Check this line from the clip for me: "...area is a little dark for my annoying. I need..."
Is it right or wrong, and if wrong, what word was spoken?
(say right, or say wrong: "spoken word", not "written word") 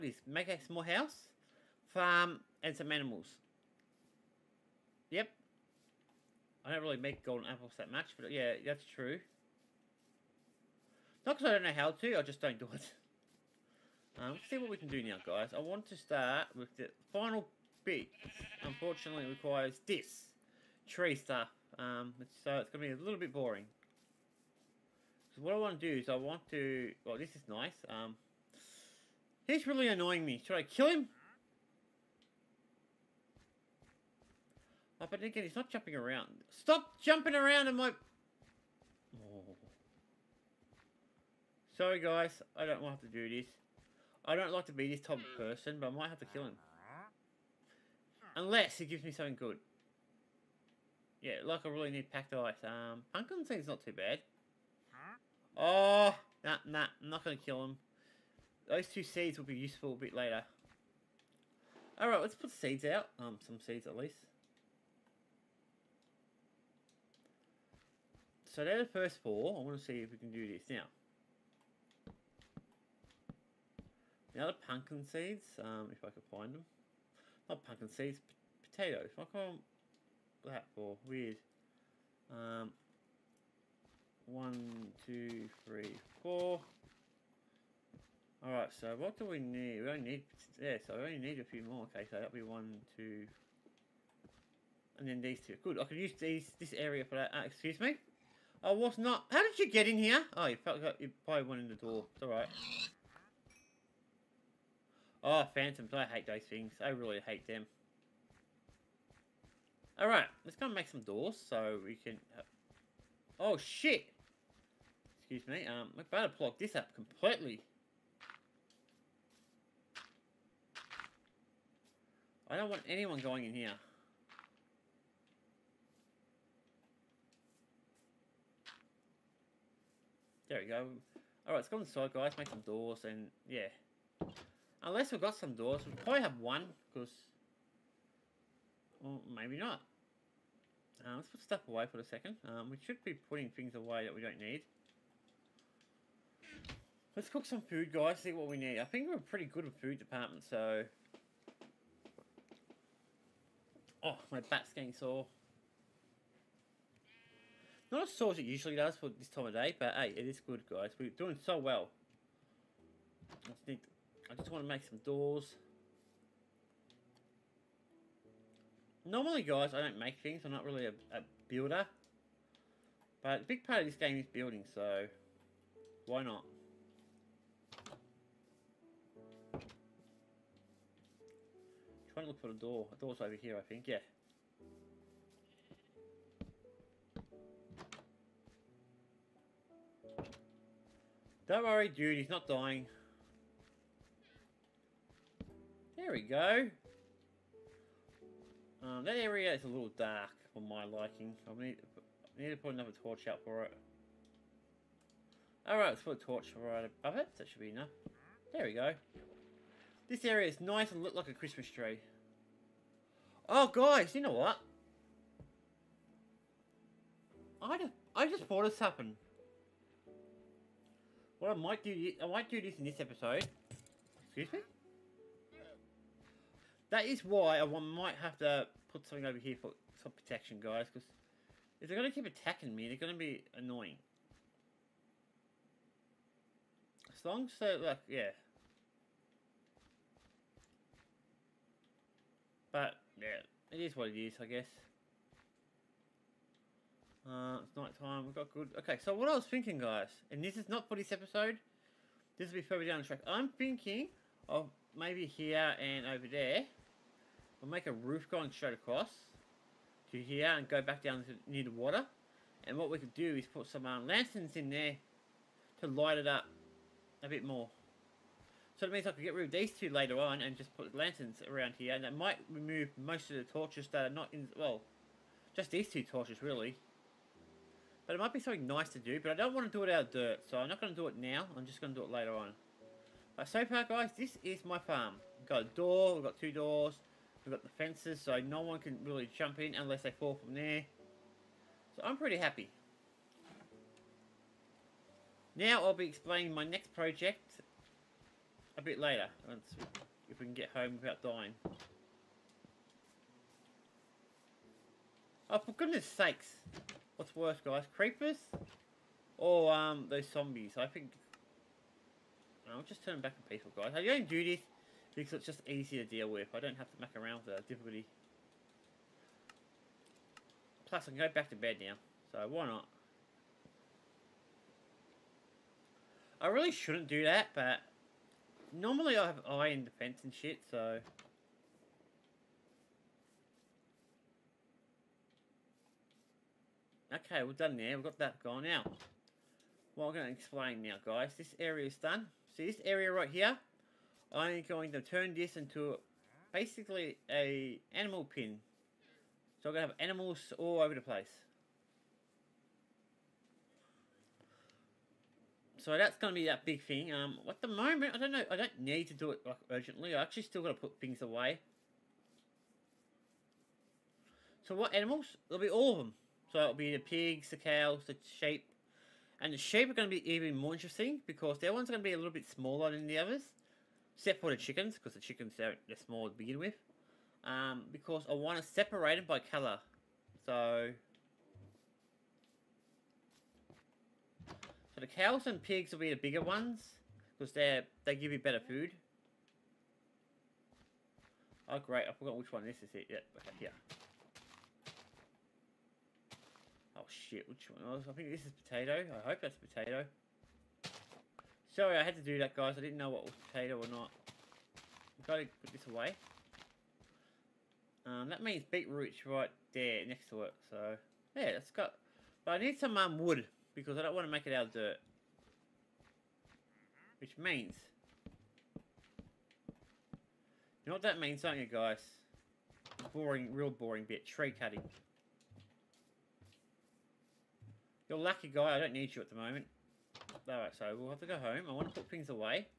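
wrong: "liking", not "annoying".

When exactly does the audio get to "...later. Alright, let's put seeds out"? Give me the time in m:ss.
1:00.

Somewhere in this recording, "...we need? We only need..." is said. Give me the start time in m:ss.
1:29.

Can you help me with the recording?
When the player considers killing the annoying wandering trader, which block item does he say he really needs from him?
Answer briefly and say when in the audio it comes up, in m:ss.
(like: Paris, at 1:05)
Packed ice, at 0:52.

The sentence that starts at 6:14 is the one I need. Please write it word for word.
Except for the chickens, because the chickens, they're, they're small to begin with.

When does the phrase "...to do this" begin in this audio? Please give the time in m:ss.
0:43.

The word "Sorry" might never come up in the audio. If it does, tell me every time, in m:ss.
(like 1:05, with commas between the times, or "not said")
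0:41, 6:41.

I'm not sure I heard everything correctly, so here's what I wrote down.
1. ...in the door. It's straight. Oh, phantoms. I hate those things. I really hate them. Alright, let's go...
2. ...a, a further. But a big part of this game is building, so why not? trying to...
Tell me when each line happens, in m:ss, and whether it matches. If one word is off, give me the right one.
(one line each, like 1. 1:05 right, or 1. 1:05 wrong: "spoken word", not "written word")
1. 1:41 wrong: "alright", not "straight"
2. 2:50 wrong: "builder", not "further".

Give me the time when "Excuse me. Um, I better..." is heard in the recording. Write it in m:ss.
1:55.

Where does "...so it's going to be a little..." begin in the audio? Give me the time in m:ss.
0:22.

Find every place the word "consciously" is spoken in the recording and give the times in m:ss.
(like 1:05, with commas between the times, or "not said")
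not said.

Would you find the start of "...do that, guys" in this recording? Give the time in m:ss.
6:42.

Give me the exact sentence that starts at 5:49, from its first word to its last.
So I'm going to have animals all over the place.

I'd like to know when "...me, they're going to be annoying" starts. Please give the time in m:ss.
3:52.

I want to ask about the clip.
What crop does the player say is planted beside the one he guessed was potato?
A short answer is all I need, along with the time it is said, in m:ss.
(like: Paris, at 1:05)
Beetroot, at 6:48.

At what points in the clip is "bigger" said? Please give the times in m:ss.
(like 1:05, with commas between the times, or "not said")
6:26.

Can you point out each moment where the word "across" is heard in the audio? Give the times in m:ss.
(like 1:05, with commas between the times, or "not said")
4:18.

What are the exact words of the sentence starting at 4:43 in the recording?
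But so far, guys, this is my farm.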